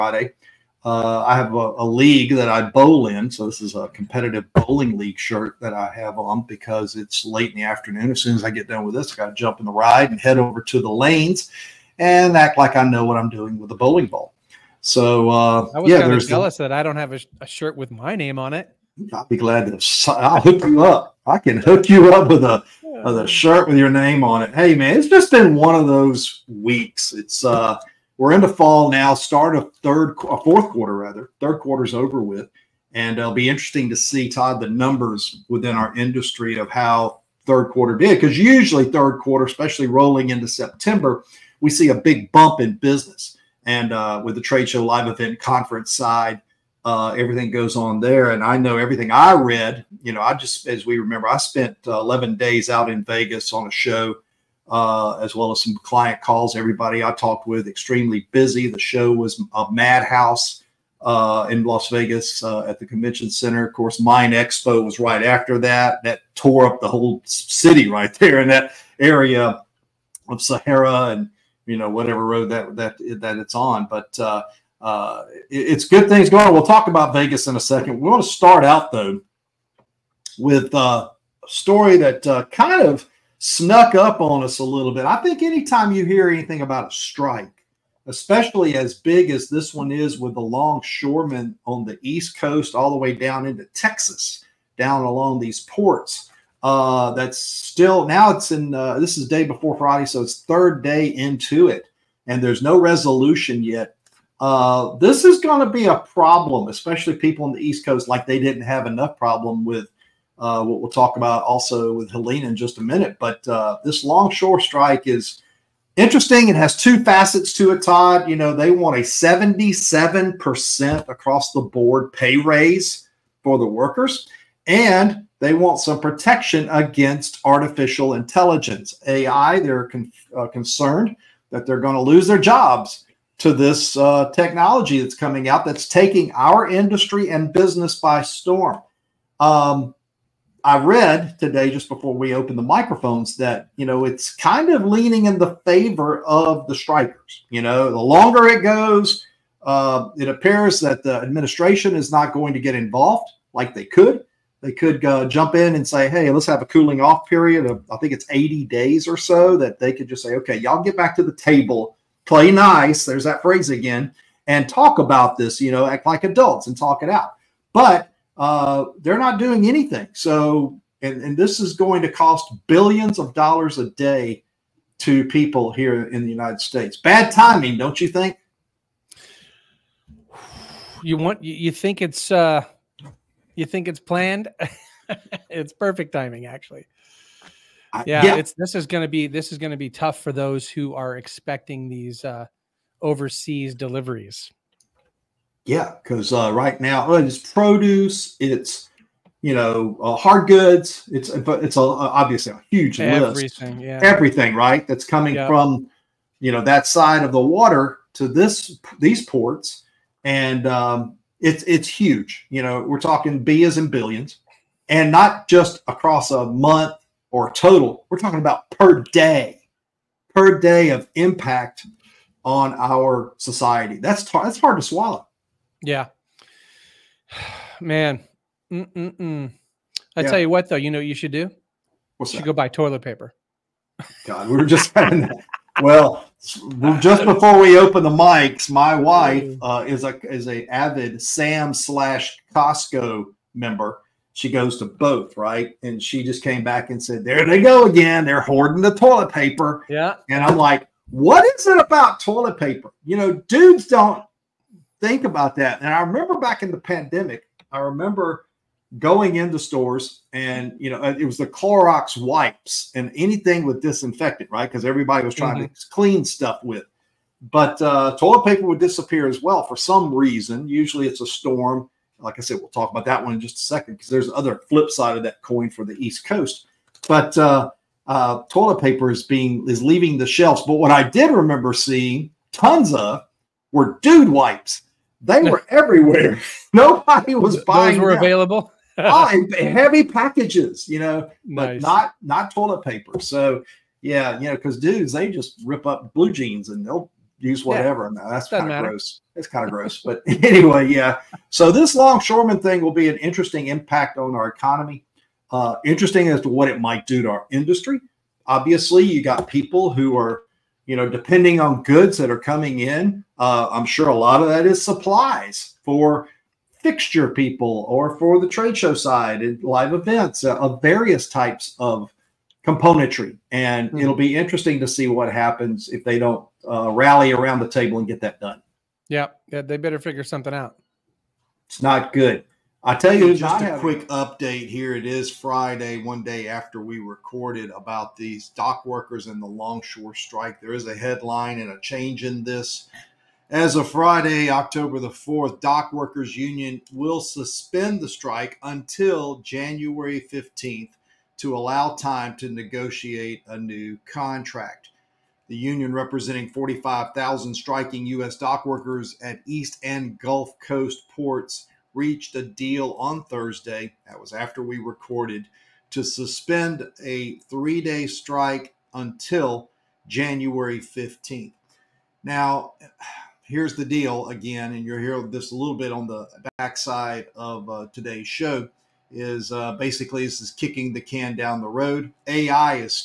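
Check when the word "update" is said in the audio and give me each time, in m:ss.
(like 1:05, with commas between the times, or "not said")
5:34.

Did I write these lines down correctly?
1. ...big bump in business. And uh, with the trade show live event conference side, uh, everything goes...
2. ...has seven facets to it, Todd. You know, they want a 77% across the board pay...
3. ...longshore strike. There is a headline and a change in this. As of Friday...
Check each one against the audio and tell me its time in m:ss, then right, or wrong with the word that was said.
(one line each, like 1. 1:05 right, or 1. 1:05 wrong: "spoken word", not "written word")
1. 0:41 right
2. 1:56 wrong: "two", not "seven"
3. 5:39 right.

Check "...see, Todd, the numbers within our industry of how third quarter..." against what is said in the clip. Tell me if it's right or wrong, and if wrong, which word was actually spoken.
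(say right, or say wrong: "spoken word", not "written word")
right.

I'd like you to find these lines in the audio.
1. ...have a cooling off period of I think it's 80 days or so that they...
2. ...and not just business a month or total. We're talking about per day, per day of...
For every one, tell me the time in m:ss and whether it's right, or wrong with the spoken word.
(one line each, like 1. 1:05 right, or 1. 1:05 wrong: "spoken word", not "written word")
1. 2:36 right
2. 3:34 wrong: "across", not "business".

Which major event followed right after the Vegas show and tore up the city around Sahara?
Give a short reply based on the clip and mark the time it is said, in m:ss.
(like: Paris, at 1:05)
MINExpo, at 1:04.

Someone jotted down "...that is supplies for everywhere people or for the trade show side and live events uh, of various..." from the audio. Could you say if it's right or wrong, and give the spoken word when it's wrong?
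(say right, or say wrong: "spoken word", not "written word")
wrong: "fixture", not "everywhere".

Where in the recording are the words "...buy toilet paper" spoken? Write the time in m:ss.
3:52.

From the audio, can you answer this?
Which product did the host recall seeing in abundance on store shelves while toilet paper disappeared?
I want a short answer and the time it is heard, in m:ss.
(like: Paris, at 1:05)
Dude wipes, at 4:44.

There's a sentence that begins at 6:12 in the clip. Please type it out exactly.
Now, here's the deal again, and you'll hear this a little bit on the backside of uh, today's show.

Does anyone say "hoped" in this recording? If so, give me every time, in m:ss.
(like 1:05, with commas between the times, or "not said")
not said.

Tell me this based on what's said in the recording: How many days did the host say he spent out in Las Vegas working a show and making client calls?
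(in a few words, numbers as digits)
11.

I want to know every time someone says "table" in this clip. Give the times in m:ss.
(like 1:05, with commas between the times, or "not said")
2:41, 5:27.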